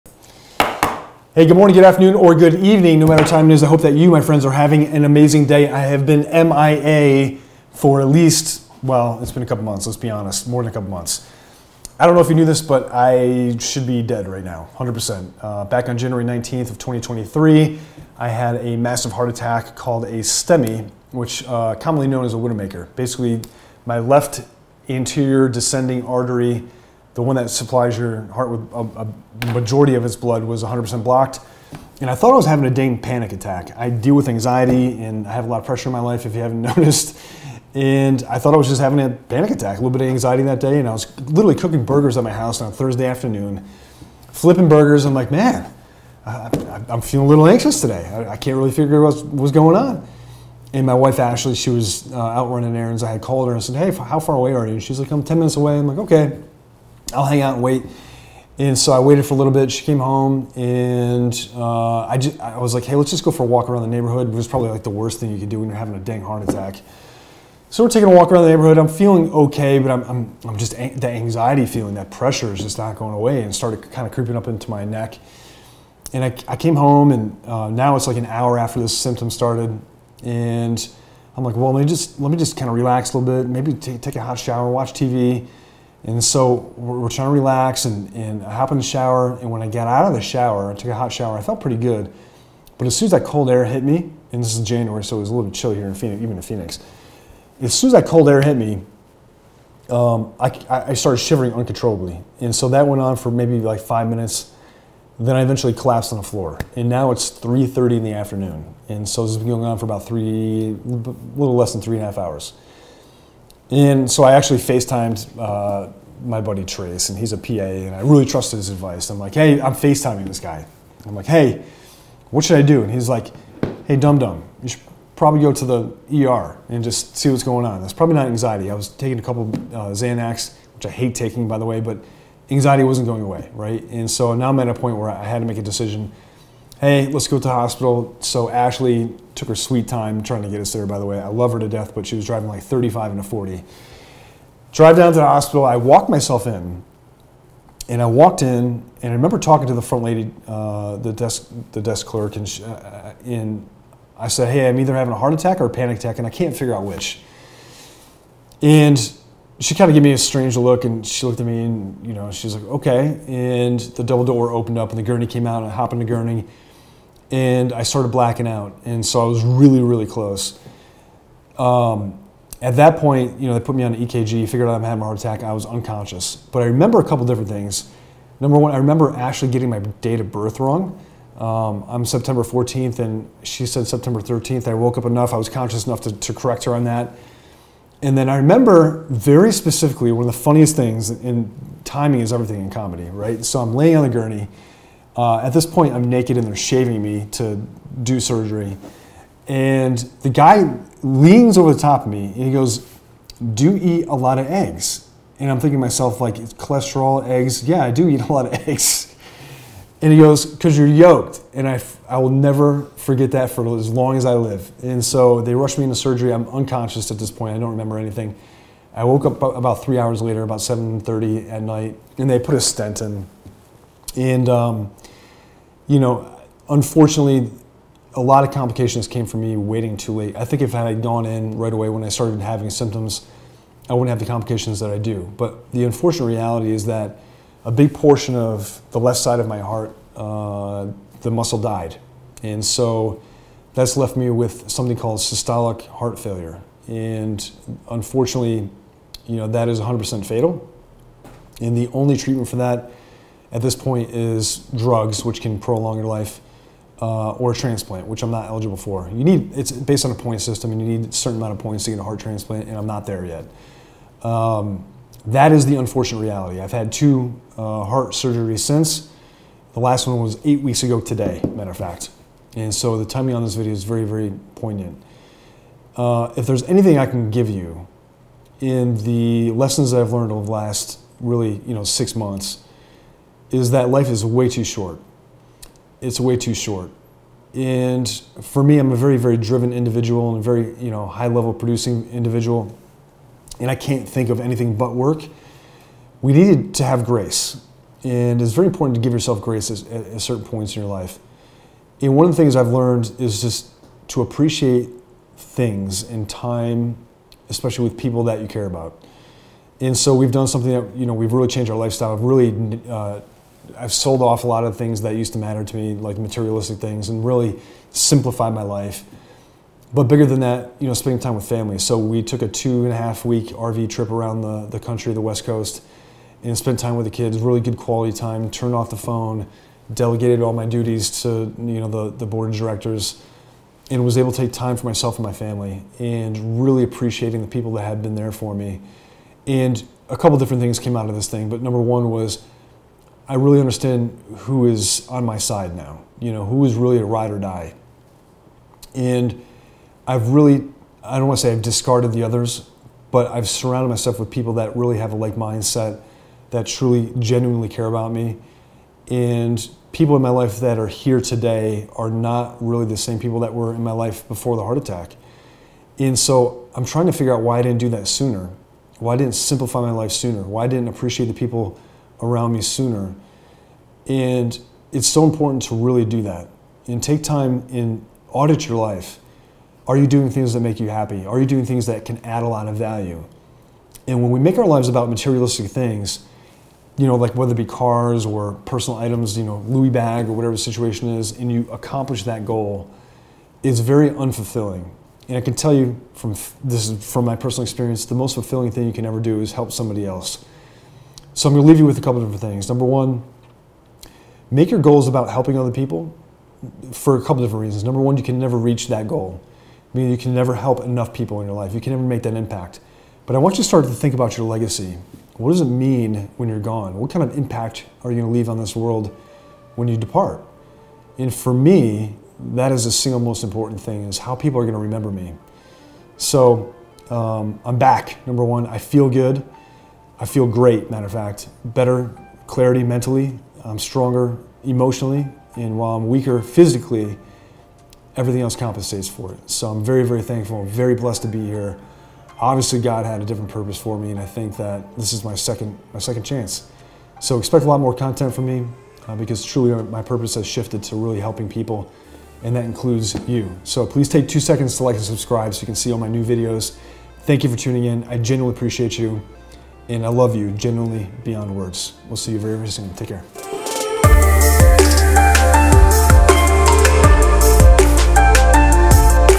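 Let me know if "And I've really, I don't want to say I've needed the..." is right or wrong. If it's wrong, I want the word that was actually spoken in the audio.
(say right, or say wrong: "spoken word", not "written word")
wrong: "discarded", not "needed".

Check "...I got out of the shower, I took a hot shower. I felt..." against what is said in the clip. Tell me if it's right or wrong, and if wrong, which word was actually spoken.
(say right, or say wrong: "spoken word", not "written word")
right.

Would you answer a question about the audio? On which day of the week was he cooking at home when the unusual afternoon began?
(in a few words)
Thursday.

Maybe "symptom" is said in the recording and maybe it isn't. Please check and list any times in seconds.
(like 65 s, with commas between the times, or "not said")
78 s, 232 s.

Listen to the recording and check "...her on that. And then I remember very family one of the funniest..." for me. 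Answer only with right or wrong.
wrong.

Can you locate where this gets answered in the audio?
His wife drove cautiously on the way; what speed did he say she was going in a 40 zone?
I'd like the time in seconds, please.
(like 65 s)
142 s.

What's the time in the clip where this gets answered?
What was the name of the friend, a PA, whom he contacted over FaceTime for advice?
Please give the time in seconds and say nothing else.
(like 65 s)
116 s.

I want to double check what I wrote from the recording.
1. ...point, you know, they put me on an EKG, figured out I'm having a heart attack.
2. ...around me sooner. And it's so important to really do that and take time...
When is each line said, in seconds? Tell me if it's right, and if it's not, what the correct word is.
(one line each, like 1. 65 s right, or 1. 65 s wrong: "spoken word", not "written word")
1. 172 s right
2. 372 s right.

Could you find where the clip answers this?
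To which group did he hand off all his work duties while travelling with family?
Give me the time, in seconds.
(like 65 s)
332 s.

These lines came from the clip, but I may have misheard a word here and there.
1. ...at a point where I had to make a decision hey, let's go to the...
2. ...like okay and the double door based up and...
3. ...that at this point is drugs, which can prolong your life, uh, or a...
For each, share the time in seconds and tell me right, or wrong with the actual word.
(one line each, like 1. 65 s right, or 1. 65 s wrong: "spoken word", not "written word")
1. 134 s right
2. 162 s wrong: "opened", not "based"
3. 252 s right.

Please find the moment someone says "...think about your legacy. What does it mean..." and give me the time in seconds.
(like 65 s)
413 s.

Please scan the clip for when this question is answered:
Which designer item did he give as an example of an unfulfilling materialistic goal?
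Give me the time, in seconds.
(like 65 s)
389 s.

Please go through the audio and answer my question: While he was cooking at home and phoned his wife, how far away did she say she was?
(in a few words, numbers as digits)
10 minutes.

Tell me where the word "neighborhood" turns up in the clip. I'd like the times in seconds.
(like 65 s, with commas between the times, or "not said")
63 s, 68 s.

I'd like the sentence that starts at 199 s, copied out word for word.
And the guy leans over the top of me and he goes, Do you eat a lot of eggs?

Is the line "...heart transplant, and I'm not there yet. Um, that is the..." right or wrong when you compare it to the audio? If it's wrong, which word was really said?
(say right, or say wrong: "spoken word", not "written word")
right.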